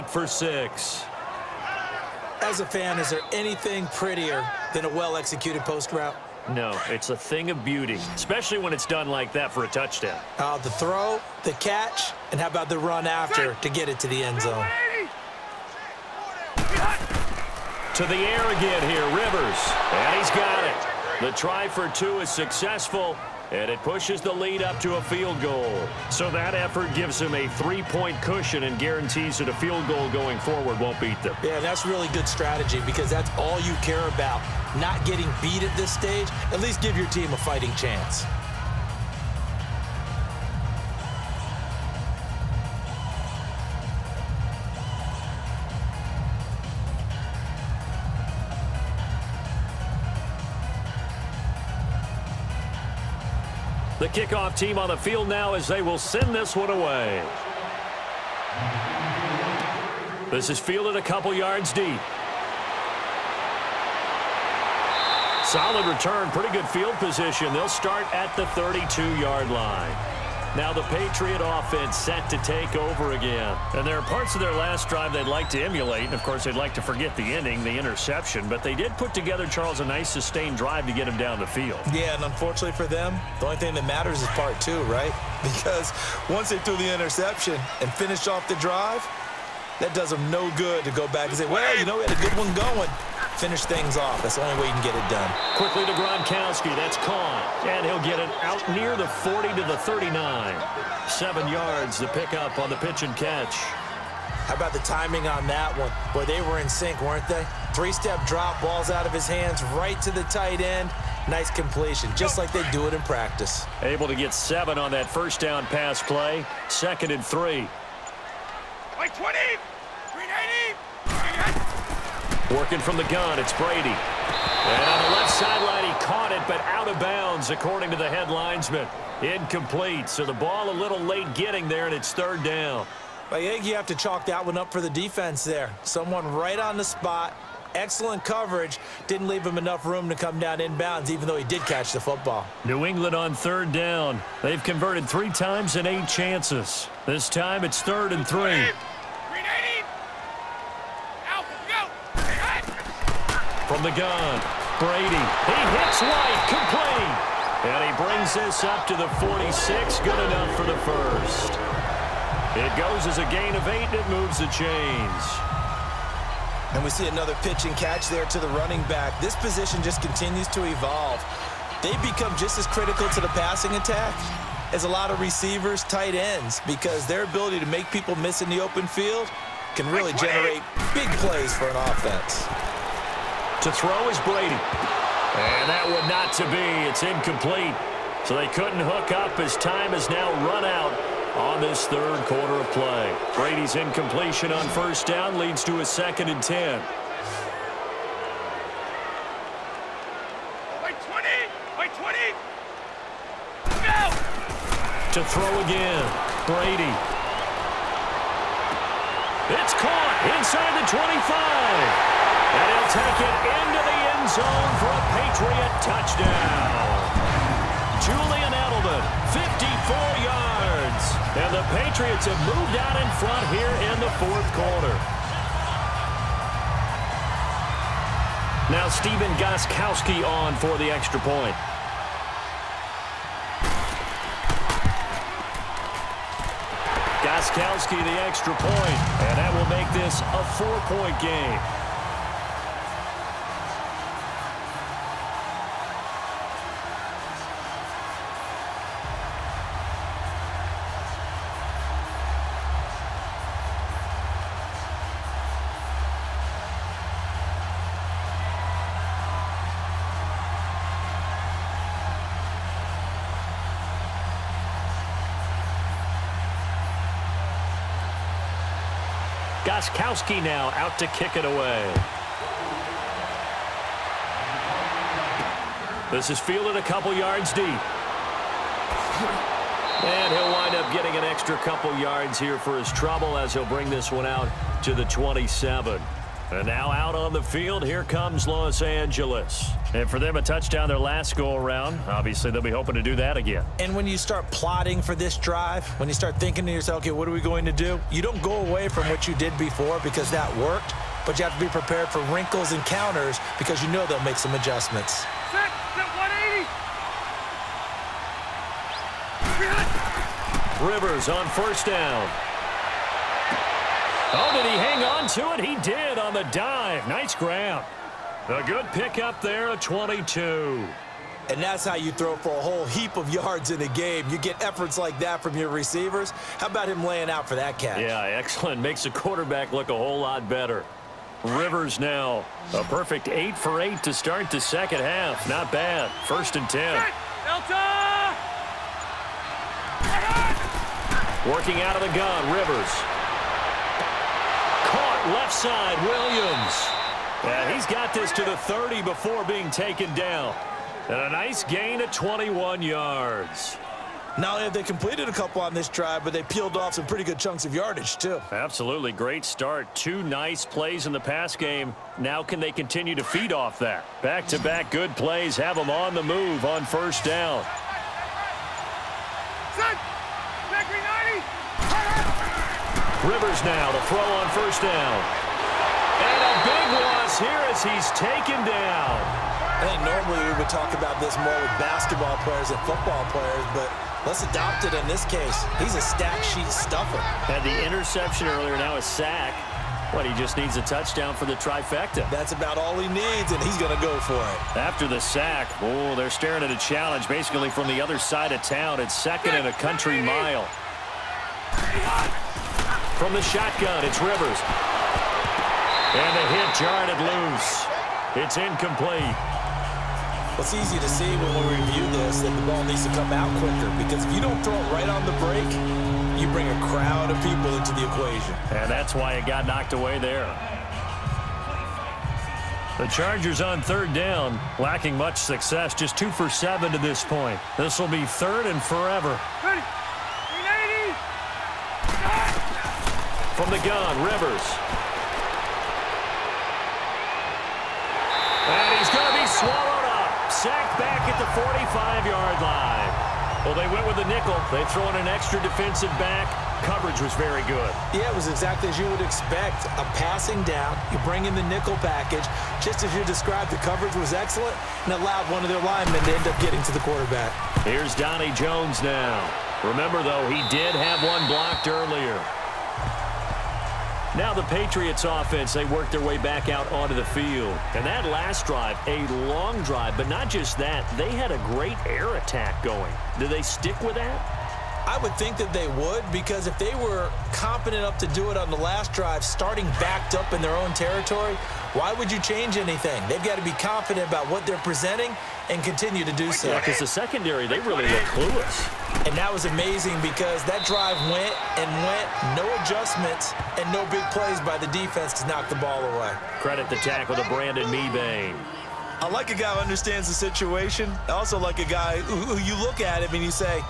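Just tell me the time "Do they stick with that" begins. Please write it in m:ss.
7:53.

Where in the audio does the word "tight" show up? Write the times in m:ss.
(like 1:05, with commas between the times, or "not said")
1:50, 2:55.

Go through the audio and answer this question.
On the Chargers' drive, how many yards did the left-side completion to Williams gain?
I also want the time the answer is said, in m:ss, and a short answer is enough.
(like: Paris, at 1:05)
21, at 5:52.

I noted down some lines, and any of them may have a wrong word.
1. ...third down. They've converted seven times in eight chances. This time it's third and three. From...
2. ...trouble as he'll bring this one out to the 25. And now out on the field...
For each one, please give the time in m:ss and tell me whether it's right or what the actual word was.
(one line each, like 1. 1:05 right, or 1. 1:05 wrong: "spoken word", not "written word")
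1. 2:23 wrong: "three", not "seven"
2. 4:42 wrong: "27", not "25".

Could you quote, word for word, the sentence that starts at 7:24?
They throw in an extra defensive back.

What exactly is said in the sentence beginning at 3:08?
So they couldn't hook up as time is now run out on this third quarter of play.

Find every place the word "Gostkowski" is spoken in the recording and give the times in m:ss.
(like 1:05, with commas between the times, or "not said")
3:49, 3:57, 4:29.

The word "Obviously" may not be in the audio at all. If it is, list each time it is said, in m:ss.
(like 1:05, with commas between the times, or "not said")
4:52.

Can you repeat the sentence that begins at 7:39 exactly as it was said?
Remember, though, he did have one blocked earlier.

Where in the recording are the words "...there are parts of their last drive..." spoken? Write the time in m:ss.
1:13.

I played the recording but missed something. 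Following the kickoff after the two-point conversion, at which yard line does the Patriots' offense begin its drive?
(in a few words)
32.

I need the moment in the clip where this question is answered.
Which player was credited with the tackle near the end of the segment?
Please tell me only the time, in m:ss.
8:17.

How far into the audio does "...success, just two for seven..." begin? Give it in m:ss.
7:05.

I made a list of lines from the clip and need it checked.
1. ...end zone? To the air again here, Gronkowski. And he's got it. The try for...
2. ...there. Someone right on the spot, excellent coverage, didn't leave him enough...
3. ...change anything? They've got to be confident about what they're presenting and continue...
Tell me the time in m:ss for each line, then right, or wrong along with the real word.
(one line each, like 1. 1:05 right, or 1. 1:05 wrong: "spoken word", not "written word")
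1. 0:14 wrong: "Rivers", not "Gronkowski"
2. 2:15 right
3. 8:02 right.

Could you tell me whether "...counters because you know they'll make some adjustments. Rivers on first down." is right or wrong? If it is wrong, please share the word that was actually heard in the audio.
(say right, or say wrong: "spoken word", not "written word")
right.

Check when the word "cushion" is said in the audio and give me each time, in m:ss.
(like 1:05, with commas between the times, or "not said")
0:28.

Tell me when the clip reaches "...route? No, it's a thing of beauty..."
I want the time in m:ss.
0:05.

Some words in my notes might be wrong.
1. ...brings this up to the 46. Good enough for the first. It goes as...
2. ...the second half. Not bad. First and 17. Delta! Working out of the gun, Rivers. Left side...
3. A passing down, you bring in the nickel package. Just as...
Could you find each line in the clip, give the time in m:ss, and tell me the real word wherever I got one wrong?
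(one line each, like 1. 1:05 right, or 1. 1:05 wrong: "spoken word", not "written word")
1. 2:38 right
2. 5:34 wrong: "10", not "17"
3. 7:29 right.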